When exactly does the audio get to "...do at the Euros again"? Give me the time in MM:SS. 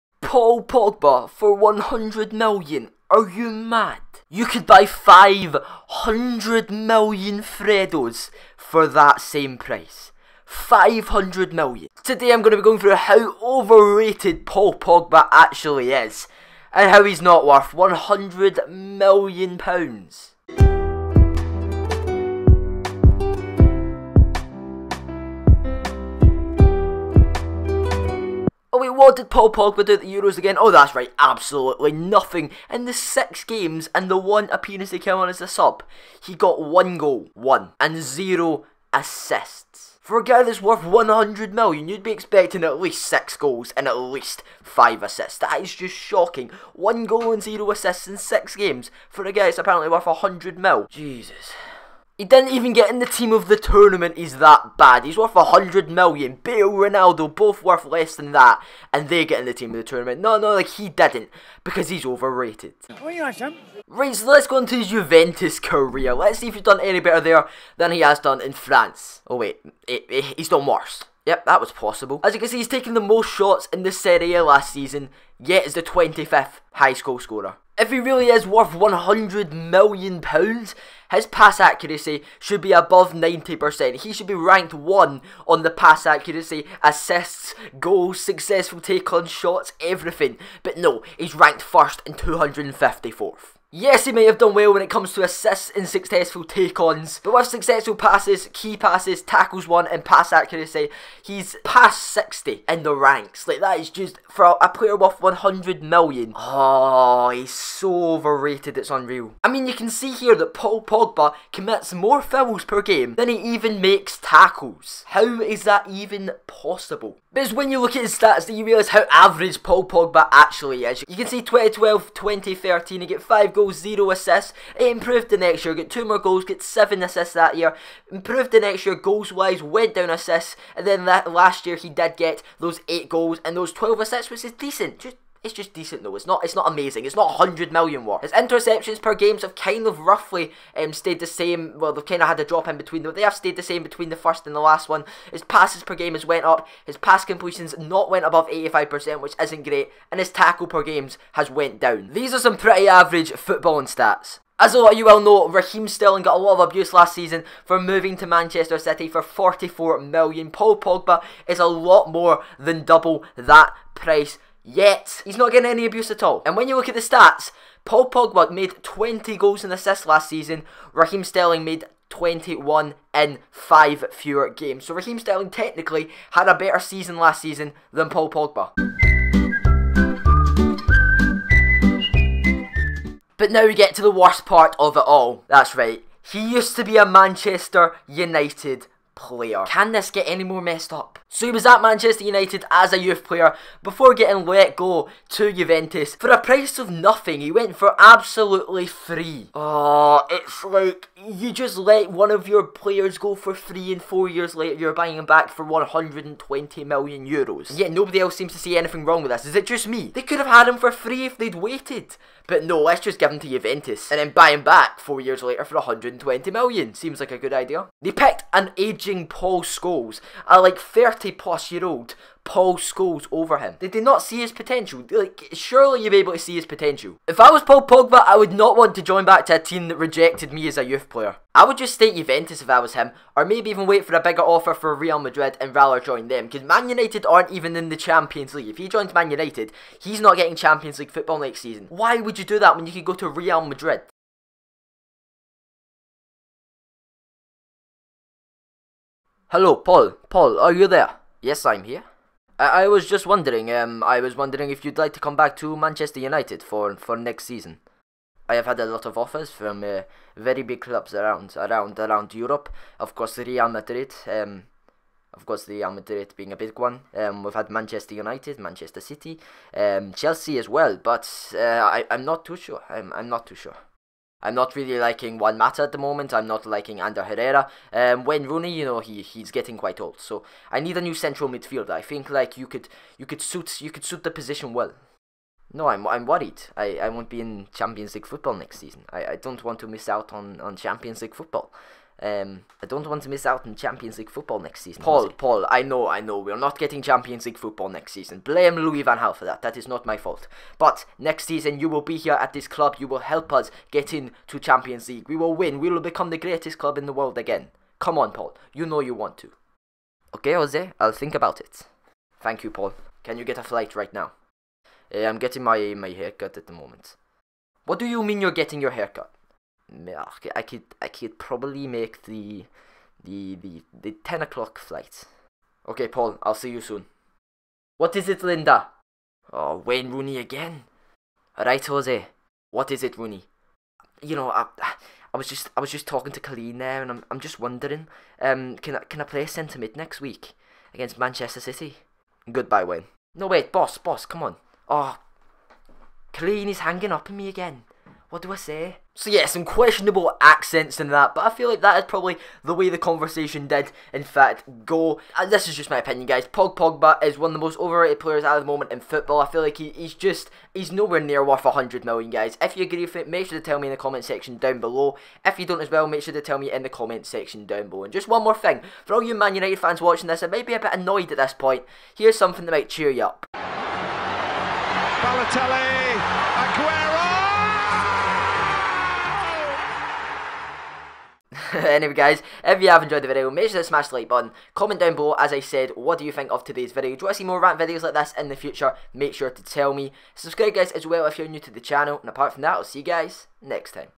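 00:29.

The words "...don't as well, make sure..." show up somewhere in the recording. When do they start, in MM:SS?
06:05.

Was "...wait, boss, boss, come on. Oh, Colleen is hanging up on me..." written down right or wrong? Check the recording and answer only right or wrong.
right.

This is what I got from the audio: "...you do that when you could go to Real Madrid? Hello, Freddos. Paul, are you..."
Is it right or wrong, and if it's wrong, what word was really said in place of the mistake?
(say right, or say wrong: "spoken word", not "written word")
wrong: "Paul", not "Freddos".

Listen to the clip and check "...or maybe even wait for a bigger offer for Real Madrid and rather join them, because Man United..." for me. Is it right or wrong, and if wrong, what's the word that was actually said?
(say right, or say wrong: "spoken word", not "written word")
right.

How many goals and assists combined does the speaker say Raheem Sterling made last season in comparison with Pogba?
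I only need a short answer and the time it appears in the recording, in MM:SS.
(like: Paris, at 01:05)
21, at 02:52.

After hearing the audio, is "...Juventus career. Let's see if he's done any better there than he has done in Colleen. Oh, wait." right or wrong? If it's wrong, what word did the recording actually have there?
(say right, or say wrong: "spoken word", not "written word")
wrong: "France", not "Colleen".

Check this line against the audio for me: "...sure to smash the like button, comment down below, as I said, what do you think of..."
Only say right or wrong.
right.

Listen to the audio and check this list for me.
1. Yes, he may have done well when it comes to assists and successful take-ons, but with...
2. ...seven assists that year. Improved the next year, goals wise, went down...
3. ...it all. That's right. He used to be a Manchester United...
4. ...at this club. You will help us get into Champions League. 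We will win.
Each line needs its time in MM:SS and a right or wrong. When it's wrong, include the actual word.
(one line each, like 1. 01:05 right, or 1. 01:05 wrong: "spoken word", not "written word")
1. 01:33 right
2. 02:06 right
3. 03:04 right
4. 05:02 right.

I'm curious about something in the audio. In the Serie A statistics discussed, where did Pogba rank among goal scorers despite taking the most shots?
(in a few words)
25th.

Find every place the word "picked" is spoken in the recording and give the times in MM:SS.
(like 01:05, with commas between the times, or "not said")
03:38.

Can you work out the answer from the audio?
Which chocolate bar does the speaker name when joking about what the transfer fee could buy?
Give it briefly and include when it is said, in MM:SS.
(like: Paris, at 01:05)
Freddos, at 00:07.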